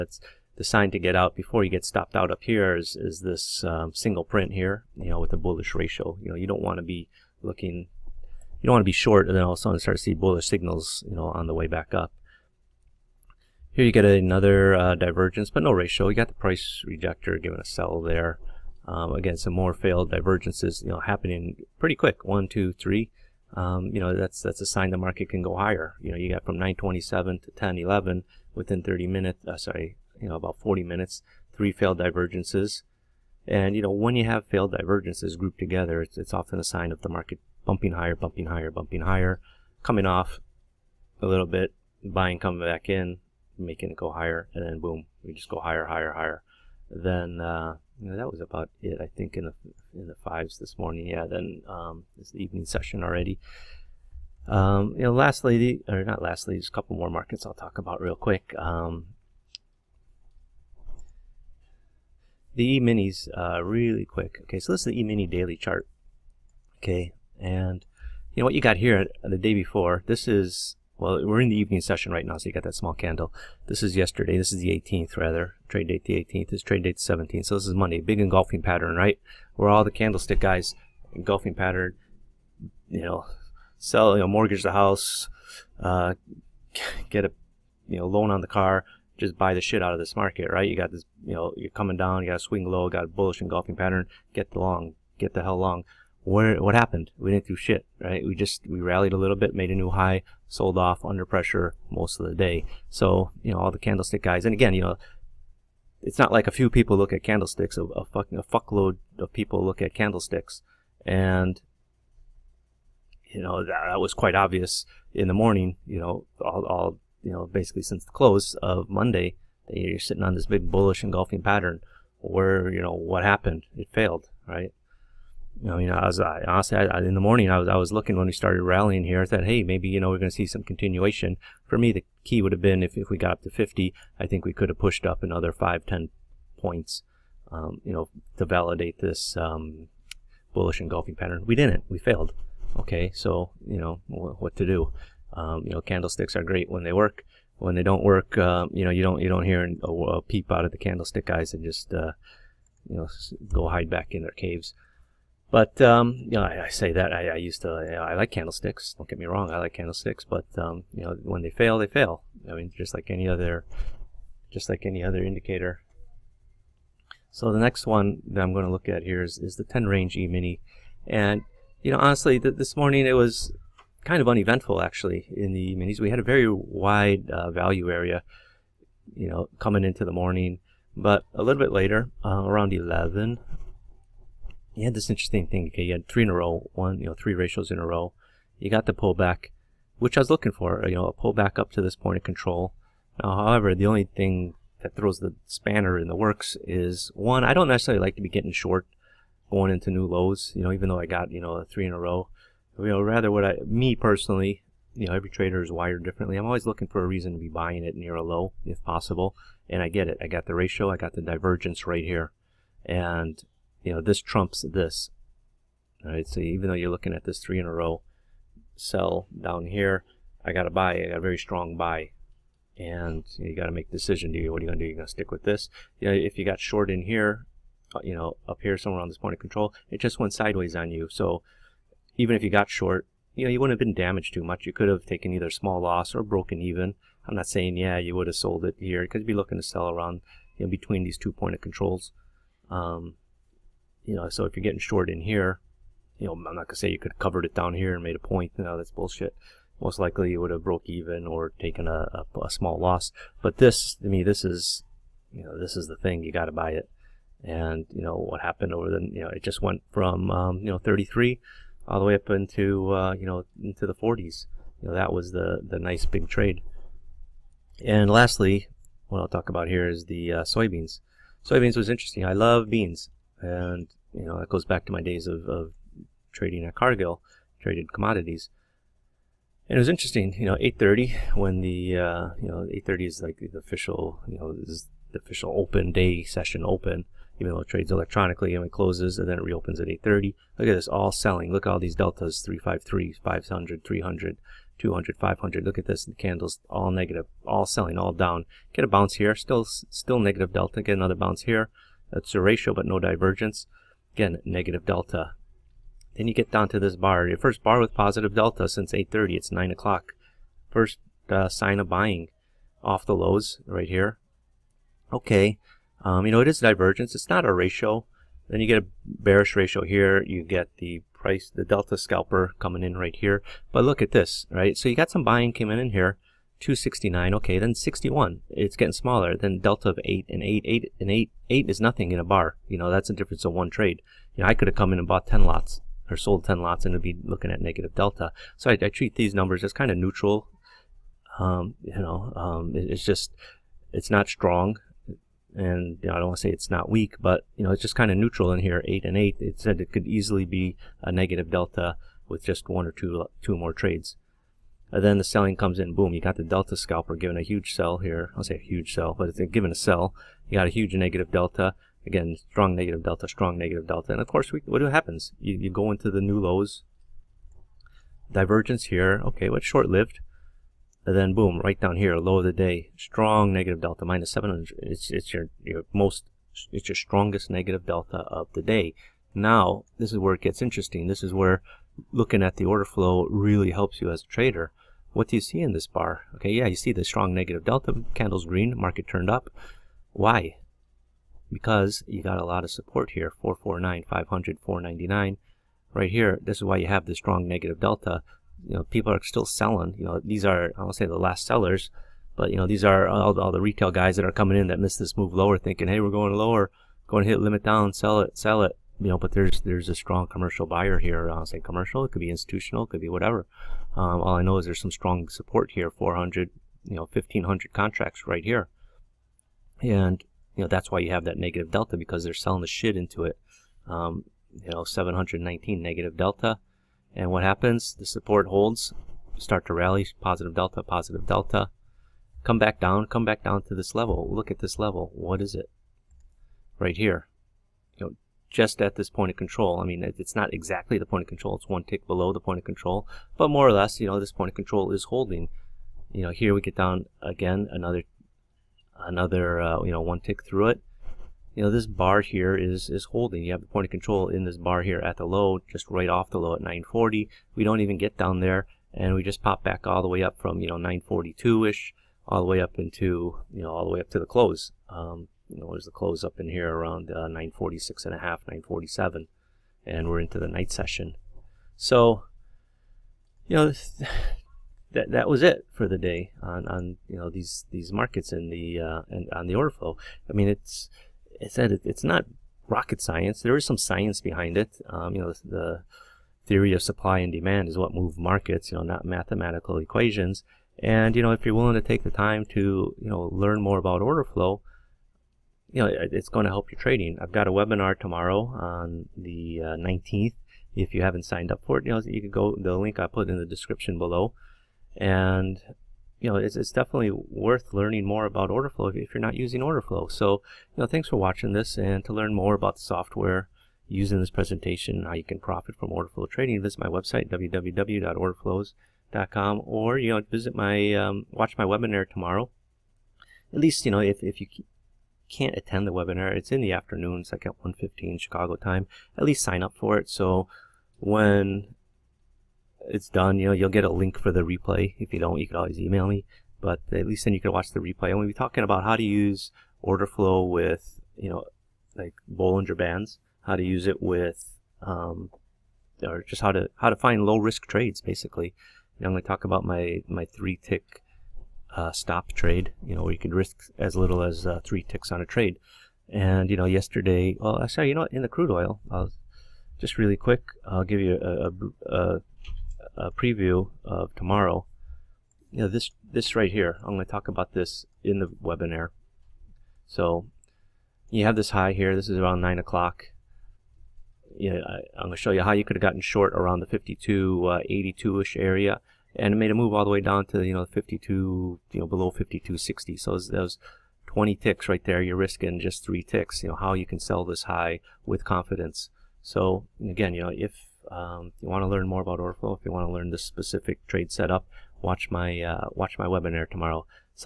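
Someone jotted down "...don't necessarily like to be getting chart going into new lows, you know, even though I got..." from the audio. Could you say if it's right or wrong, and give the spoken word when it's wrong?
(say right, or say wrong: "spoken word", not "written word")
wrong: "short", not "chart".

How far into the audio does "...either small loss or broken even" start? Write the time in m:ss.
3:55.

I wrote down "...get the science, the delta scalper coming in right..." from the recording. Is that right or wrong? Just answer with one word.
wrong.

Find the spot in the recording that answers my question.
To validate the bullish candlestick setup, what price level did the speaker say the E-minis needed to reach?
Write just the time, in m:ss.
2:13.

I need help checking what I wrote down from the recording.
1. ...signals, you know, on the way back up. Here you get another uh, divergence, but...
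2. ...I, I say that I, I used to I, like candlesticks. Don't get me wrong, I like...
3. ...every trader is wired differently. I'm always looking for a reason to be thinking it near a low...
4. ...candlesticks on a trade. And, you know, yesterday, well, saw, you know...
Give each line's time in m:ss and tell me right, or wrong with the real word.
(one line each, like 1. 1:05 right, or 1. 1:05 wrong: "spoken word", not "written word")
1. 0:10 right
2. 2:36 right
3. 3:25 wrong: "buying", not "thinking"
4. 9:14 wrong: "ticks", not "candlesticks".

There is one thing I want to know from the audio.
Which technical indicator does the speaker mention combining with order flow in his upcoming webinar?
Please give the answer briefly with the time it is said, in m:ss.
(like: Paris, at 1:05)
Bollinger Bands, at 9:02.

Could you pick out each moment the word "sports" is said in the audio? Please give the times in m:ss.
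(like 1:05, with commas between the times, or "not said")
not said.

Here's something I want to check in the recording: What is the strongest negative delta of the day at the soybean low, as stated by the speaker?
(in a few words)
-700.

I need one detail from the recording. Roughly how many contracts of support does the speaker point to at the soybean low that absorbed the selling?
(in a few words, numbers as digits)
1500.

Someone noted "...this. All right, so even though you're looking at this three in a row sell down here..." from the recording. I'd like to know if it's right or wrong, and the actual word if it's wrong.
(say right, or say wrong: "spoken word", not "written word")
right.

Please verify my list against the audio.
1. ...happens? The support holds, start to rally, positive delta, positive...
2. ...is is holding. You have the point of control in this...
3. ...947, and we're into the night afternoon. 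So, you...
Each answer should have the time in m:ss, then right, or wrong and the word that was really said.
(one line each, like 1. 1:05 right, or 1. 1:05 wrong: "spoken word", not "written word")
1. 7:07 right
2. 7:32 right
3. 7:48 wrong: "session", not "afternoon".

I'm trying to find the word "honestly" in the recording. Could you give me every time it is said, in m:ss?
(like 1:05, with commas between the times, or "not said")
2:06, 2:51.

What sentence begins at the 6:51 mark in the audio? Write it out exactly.
I'll uh, say commercial, it could be institutional, it could be whatever.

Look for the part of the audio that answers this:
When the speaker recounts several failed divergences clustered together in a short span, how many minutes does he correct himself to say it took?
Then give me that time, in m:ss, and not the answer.
0:30.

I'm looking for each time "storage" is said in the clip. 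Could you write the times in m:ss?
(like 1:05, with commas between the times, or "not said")
not said.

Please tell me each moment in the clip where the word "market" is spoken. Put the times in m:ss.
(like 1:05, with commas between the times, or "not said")
0:24, 0:37, 0:57, 1:30, 6:28, 7:57, 8:08.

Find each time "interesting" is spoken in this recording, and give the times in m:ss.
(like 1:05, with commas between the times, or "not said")
3:05, 4:31, 4:39, 6:20.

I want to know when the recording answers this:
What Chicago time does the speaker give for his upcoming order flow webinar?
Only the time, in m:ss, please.
8:47.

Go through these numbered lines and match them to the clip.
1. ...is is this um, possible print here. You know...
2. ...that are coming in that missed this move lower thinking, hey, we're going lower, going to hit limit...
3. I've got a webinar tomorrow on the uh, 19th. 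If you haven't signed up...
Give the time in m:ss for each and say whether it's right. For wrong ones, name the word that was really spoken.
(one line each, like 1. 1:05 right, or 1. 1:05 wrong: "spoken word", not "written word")
1. 0:02 wrong: "single", not "possible"
2. 6:44 right
3. 8:17 right.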